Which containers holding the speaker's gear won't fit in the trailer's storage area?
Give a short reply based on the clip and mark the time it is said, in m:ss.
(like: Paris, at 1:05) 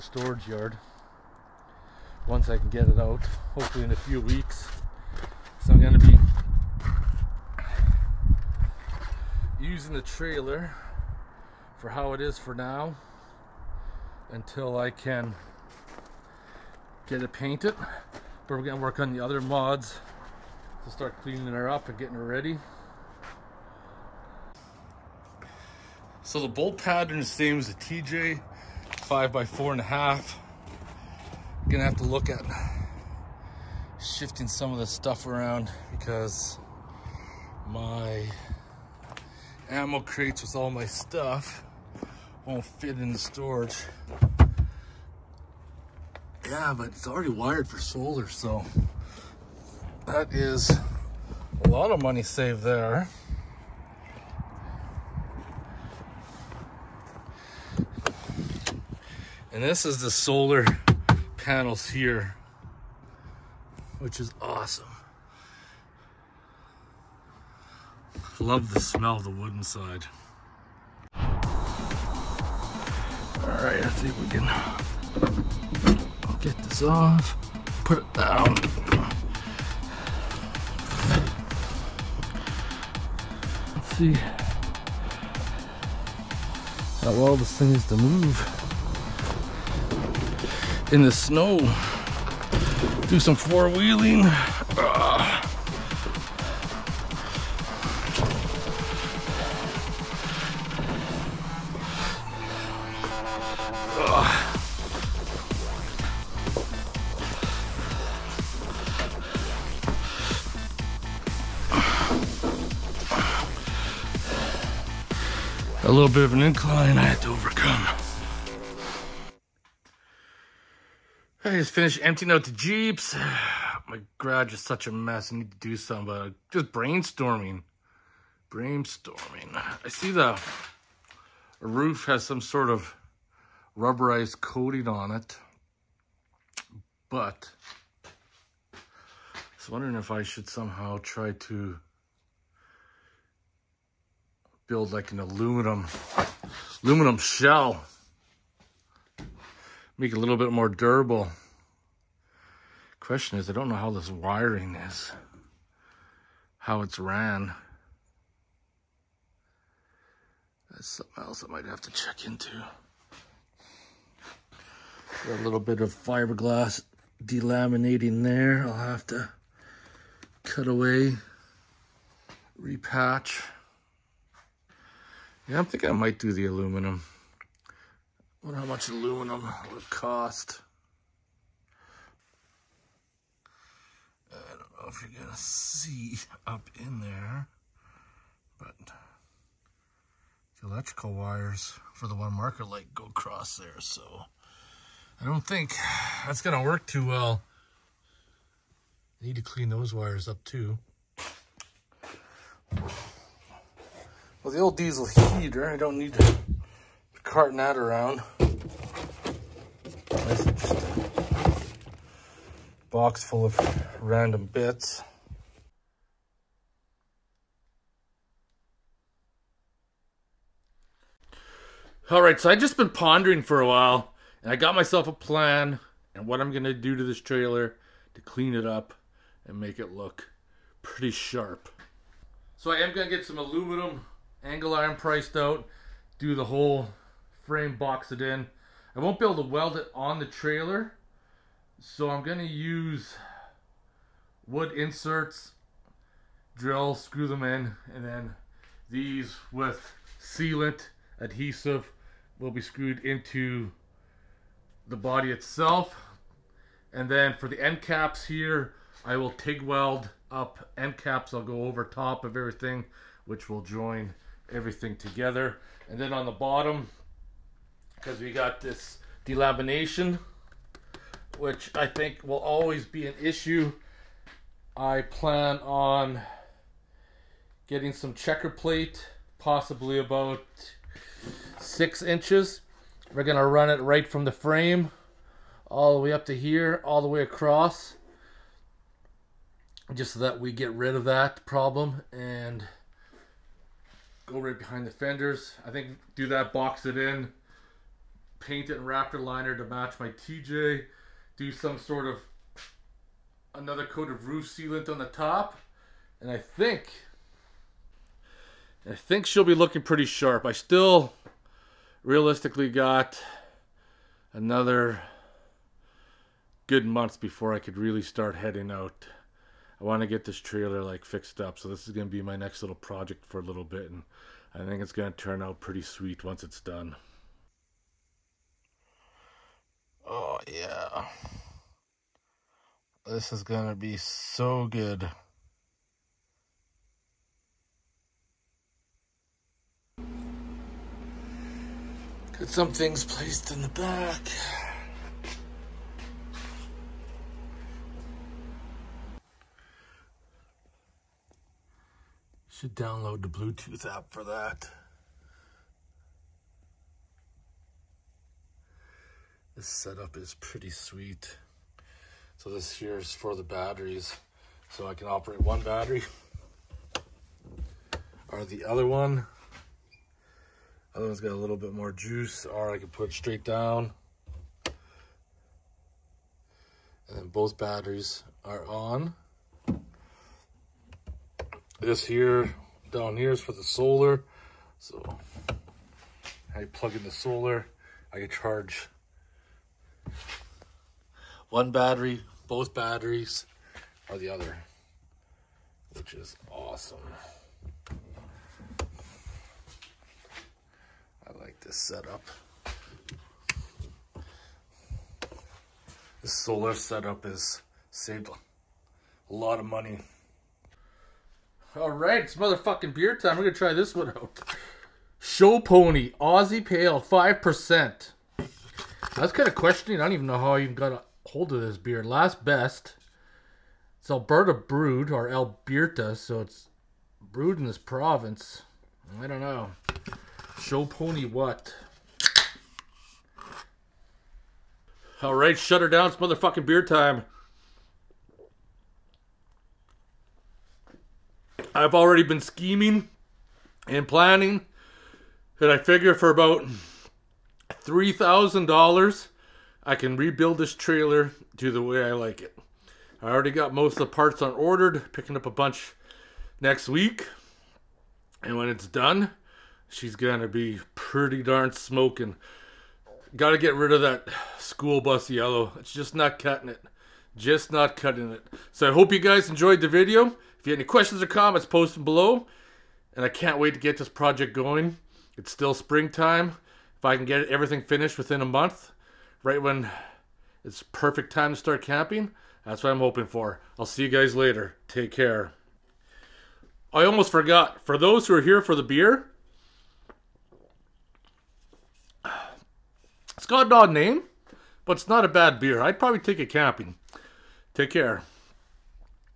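Ammo crates, at 0:39.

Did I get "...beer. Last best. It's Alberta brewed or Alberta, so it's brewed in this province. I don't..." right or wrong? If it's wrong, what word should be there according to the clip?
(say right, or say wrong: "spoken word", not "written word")
right.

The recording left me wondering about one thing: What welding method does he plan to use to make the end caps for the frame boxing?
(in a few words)
TIG.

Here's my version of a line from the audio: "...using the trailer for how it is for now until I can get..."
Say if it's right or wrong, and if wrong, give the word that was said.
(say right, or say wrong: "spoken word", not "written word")
right.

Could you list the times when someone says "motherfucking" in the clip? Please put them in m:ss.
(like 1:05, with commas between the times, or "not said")
6:52, 7:16.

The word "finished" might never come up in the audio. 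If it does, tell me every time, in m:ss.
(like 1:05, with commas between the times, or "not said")
2:01, 7:57.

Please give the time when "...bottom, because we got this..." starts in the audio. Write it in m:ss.
4:26.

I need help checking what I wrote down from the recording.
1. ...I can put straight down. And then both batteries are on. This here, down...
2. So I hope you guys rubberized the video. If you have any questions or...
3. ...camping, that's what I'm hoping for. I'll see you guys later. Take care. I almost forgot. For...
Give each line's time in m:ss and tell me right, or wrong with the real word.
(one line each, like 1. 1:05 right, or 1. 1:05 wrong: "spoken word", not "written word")
1. 6:12 right
2. 7:48 wrong: "enjoyed", not "rubberized"
3. 8:01 right.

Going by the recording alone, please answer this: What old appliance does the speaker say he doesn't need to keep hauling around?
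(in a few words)
Diesel heater.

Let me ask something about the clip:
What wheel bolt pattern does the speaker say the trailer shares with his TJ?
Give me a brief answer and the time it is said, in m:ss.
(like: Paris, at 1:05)
5 by 4.5, at 0:28.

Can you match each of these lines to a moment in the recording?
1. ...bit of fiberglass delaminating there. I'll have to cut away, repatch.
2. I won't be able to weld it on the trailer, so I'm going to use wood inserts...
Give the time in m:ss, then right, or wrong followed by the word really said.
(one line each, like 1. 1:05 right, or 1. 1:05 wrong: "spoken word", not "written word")
1. 2:45 right
2. 3:58 right.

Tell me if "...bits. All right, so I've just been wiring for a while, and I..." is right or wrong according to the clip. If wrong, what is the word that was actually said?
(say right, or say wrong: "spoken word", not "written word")
wrong: "pondering", not "wiring".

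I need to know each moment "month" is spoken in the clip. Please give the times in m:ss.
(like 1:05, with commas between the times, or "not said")
5:16, 7:58.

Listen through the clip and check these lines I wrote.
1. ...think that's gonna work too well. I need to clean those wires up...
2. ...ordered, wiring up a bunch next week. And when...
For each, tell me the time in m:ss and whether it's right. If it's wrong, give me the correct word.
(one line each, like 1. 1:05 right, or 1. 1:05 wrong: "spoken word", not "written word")
1. 3:15 right
2. 7:34 wrong: "picking", not "wiring".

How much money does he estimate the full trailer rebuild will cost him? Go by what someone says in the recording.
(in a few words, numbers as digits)
$3,000.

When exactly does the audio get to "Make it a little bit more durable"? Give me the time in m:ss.
2:29.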